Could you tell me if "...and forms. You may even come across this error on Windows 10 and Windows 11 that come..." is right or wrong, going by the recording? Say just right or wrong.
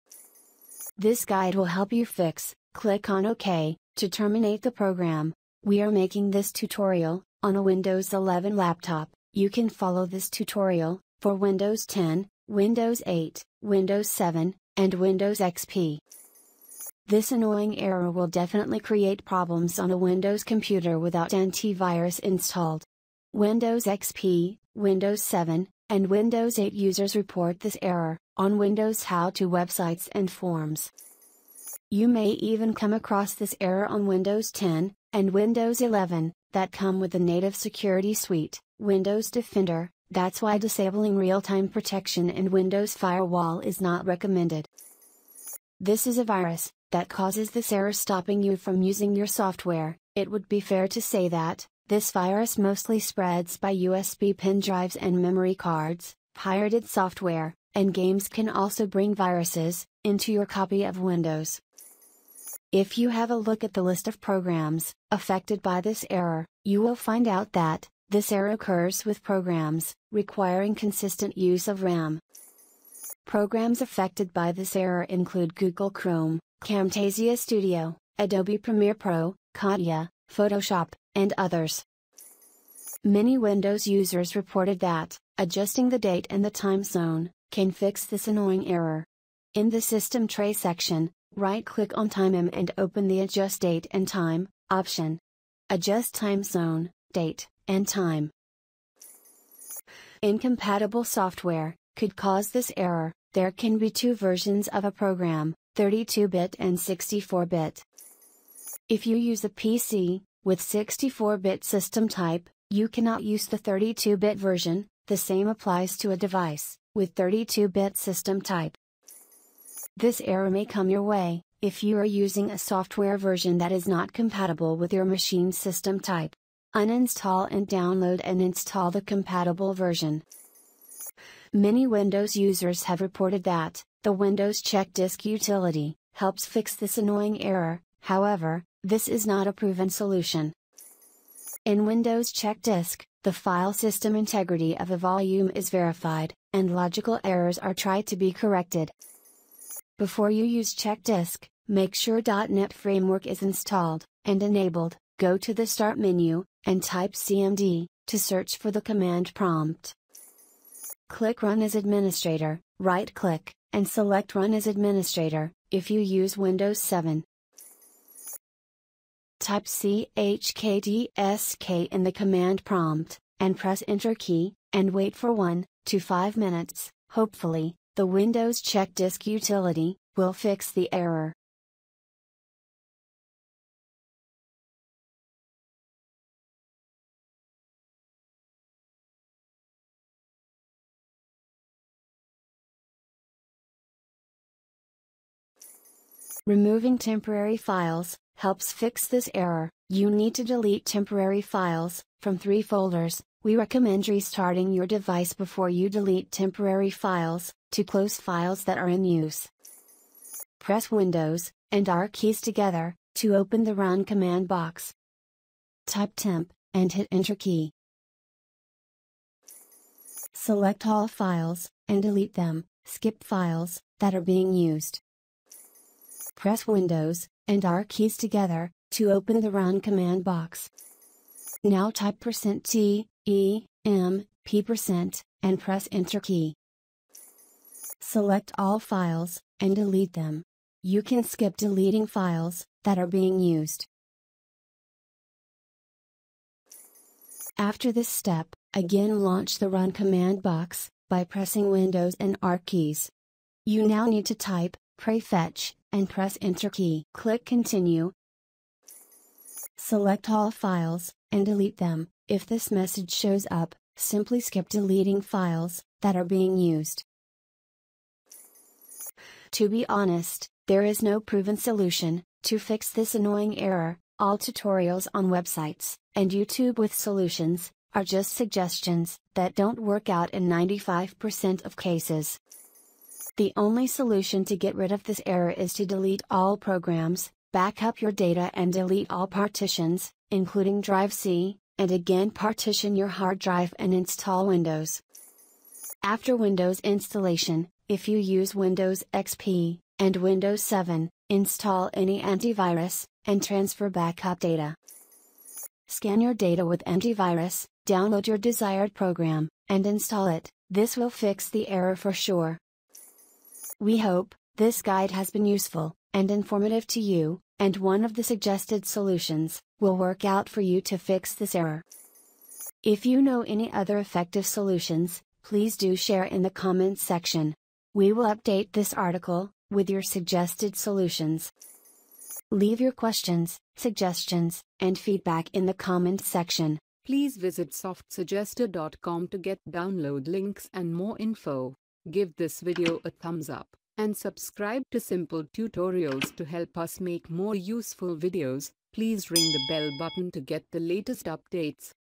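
right.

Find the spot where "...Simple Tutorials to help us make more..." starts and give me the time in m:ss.
5:44.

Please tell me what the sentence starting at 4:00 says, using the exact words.
You can skip deleting files that are being used.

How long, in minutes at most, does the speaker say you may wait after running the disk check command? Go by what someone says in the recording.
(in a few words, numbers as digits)
5 minutes.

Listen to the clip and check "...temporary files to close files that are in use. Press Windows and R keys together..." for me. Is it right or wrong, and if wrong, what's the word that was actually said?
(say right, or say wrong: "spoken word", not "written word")
right.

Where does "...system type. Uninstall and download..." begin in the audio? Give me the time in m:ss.
2:05.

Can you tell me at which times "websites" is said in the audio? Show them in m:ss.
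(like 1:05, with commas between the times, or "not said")
0:29, 4:35.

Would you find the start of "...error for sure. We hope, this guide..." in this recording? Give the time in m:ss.
5:11.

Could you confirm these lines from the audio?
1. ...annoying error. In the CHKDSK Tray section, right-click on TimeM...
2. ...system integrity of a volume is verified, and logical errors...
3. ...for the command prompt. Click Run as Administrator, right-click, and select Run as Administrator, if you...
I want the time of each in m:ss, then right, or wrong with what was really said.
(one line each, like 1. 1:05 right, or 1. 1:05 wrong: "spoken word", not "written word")
1. 1:28 wrong: "System", not "CHKDSK"
2. 2:23 right
3. 2:38 right.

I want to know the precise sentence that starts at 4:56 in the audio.
After Windows installation, if you use Windows XP and Windows 7, install any antivirus, and transfer backup data.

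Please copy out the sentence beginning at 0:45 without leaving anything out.
This is a virus that causes this error stopping you from using your software.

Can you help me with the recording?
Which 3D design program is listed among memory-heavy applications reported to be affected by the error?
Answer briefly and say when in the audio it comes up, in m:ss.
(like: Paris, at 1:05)
CATIA, at 1:19.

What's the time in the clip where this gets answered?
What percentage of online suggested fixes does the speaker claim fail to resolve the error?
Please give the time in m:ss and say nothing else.
4:40.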